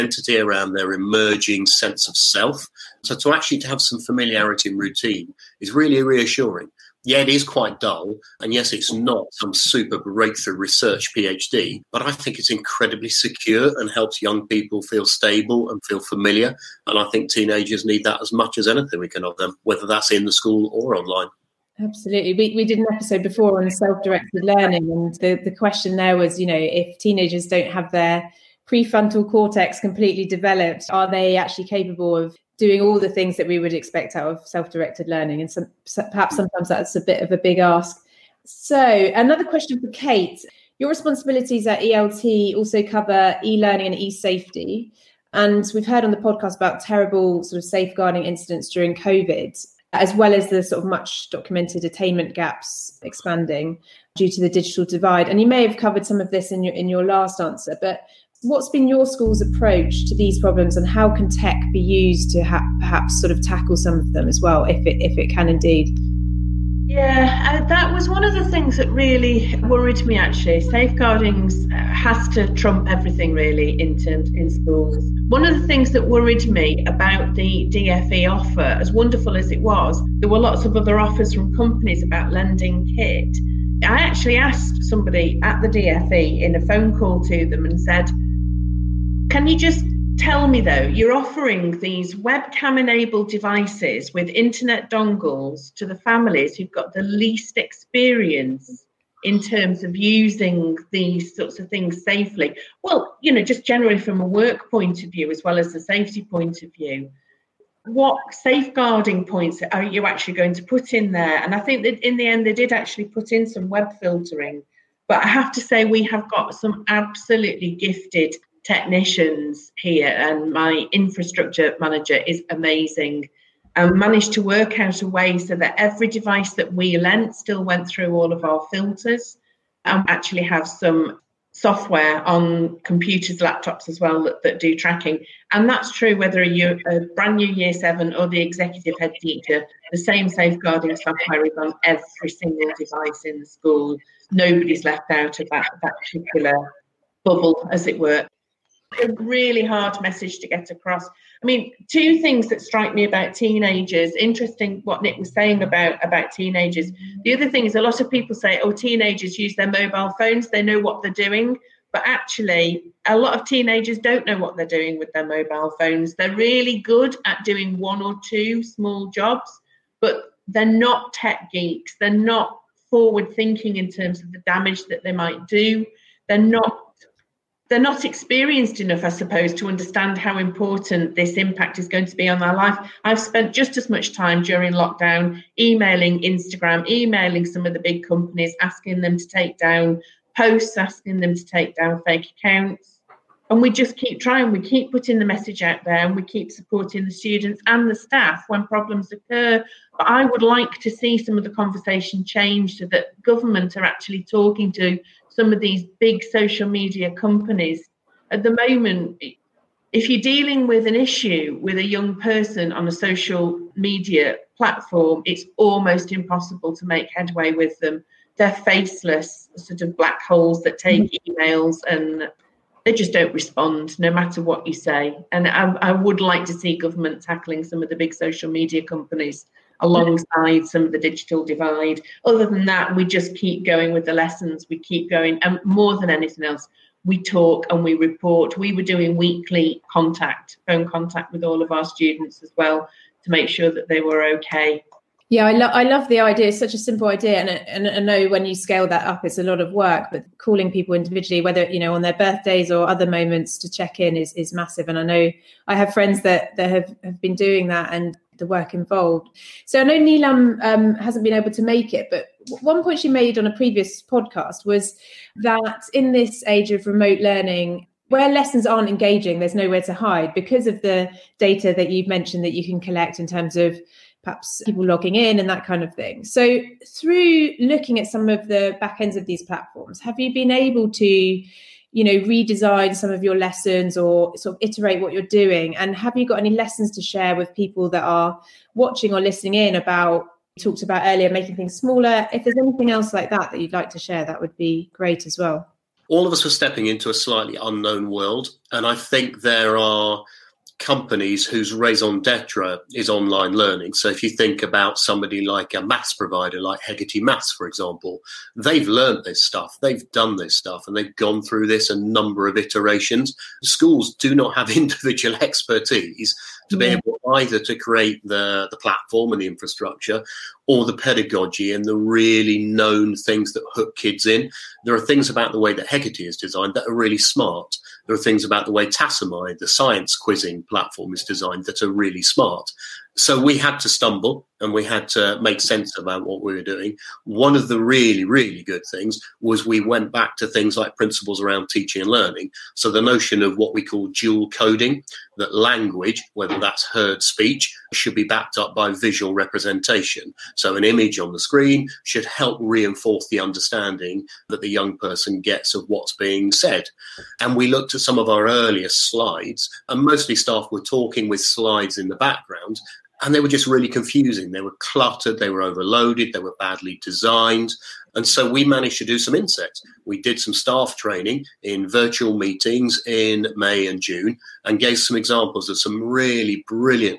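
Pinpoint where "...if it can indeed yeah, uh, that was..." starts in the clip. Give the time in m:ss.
1:04.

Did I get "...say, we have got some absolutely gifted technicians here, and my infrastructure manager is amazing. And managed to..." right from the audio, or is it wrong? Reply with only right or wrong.
right.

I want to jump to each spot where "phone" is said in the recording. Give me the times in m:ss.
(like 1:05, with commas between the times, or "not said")
1:26, 2:40, 2:45, 4:00.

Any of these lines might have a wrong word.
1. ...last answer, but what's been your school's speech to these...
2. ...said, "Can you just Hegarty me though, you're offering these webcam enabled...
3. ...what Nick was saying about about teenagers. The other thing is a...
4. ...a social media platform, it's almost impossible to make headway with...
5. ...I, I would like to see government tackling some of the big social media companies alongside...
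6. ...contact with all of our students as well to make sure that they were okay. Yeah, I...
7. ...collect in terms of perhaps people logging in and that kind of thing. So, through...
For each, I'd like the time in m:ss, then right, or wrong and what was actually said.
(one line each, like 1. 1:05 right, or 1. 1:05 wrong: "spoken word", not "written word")
1. 0:57 wrong: "approach", not "speech"
2. 1:27 wrong: "Tell", not "Hegarty"
3. 2:34 right
4. 3:32 right
5. 3:45 right
6. 4:00 right
7. 4:32 right.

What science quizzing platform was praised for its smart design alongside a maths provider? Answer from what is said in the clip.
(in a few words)
Tassomai.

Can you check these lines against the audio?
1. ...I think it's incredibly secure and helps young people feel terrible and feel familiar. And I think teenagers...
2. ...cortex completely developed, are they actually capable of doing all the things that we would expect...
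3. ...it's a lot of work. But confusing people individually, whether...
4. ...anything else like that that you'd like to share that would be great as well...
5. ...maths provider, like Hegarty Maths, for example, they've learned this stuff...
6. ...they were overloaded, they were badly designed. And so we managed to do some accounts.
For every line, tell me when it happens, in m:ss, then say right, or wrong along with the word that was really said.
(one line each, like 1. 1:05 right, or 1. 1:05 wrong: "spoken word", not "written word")
1. 0:12 wrong: "stable", not "terrible"
2. 0:29 right
3. 4:09 wrong: "calling", not "confusing"
4. 4:52 right
5. 5:05 right
6. 6:05 wrong: "insets", not "accounts".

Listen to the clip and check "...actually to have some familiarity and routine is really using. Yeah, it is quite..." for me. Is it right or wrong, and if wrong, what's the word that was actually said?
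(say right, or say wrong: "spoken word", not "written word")
wrong: "reassuring", not "using".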